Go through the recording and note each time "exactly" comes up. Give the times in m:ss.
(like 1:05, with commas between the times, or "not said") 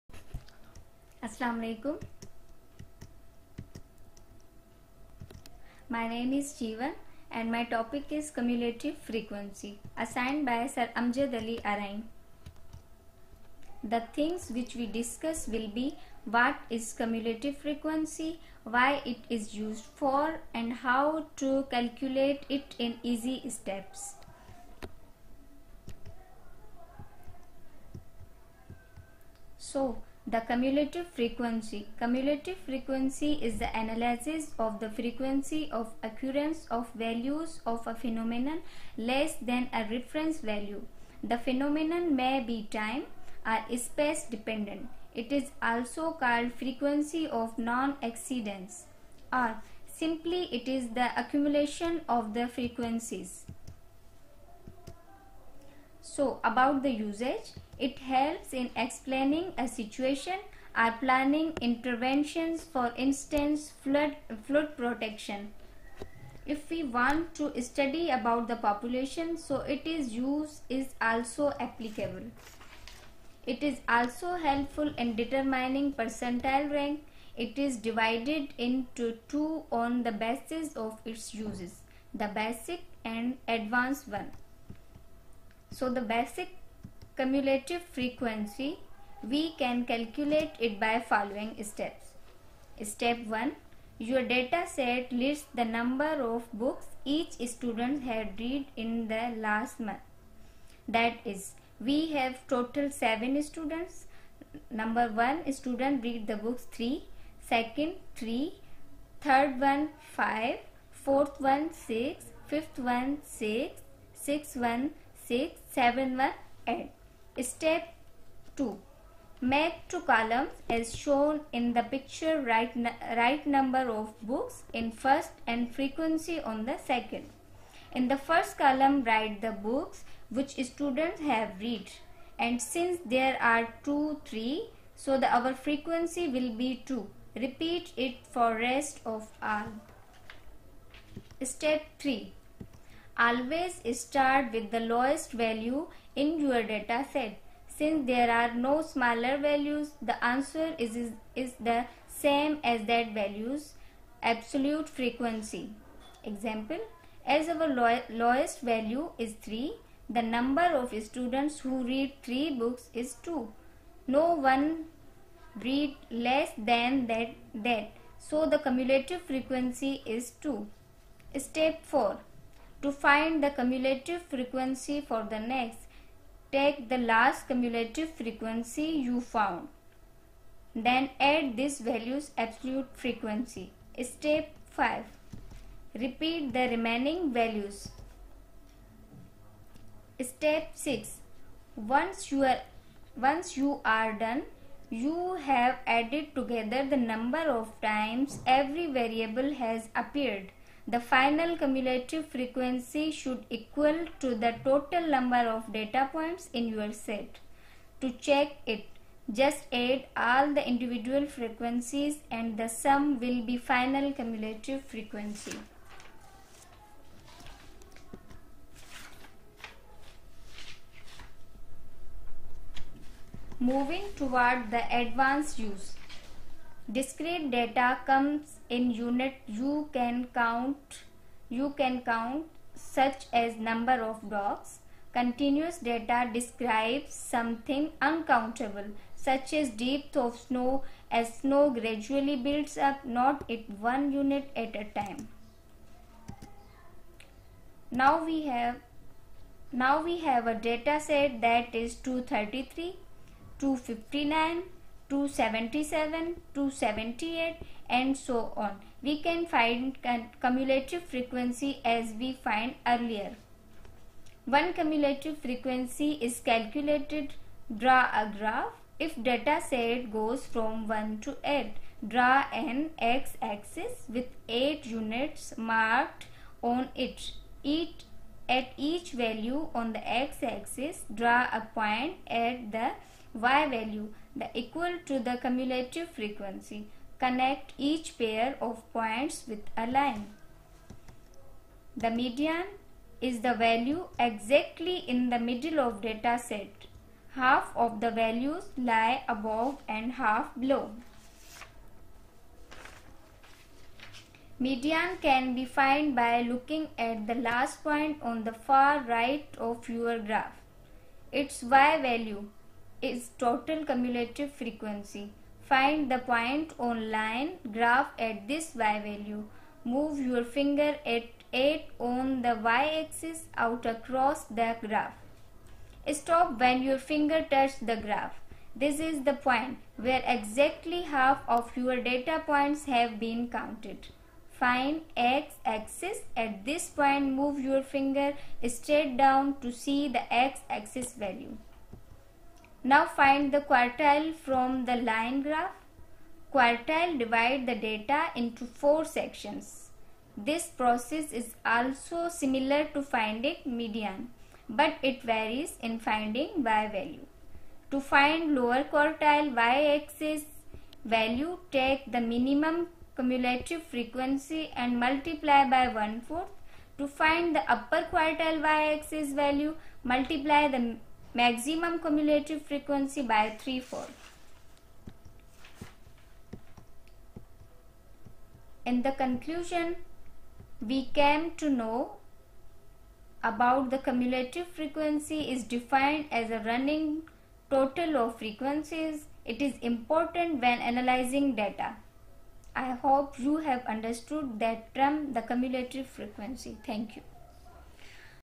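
4:54, 5:30.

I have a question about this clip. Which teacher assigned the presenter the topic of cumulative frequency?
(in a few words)
Amjad Ali Arain.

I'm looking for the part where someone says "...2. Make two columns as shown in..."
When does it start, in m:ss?
1:58.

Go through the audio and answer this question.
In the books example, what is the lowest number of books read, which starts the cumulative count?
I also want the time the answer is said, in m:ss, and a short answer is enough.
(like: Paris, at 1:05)
3, at 2:37.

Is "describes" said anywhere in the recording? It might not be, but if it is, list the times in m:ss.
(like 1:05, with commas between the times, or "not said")
3:56.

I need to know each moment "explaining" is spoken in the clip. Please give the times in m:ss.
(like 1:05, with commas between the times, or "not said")
0:58.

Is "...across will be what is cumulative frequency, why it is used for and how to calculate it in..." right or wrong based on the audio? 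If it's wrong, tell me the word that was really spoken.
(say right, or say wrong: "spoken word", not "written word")
wrong: "discuss", not "across".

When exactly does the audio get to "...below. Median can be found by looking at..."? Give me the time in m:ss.
5:00.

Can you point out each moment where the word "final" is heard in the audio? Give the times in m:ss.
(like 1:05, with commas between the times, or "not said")
3:20, 3:33.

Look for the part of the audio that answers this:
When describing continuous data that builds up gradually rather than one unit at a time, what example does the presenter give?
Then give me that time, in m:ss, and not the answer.
3:59.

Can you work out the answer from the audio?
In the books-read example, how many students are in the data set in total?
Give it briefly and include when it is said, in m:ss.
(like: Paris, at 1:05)
7, at 1:42.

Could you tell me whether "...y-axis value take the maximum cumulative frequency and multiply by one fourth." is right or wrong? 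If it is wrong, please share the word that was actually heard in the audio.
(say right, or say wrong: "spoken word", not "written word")
wrong: "minimum", not "maximum".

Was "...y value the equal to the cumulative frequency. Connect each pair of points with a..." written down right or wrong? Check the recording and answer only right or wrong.
right.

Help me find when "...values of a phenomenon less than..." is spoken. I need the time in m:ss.
0:36.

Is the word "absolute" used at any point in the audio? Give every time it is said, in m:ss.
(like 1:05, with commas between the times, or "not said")
2:34, 3:02.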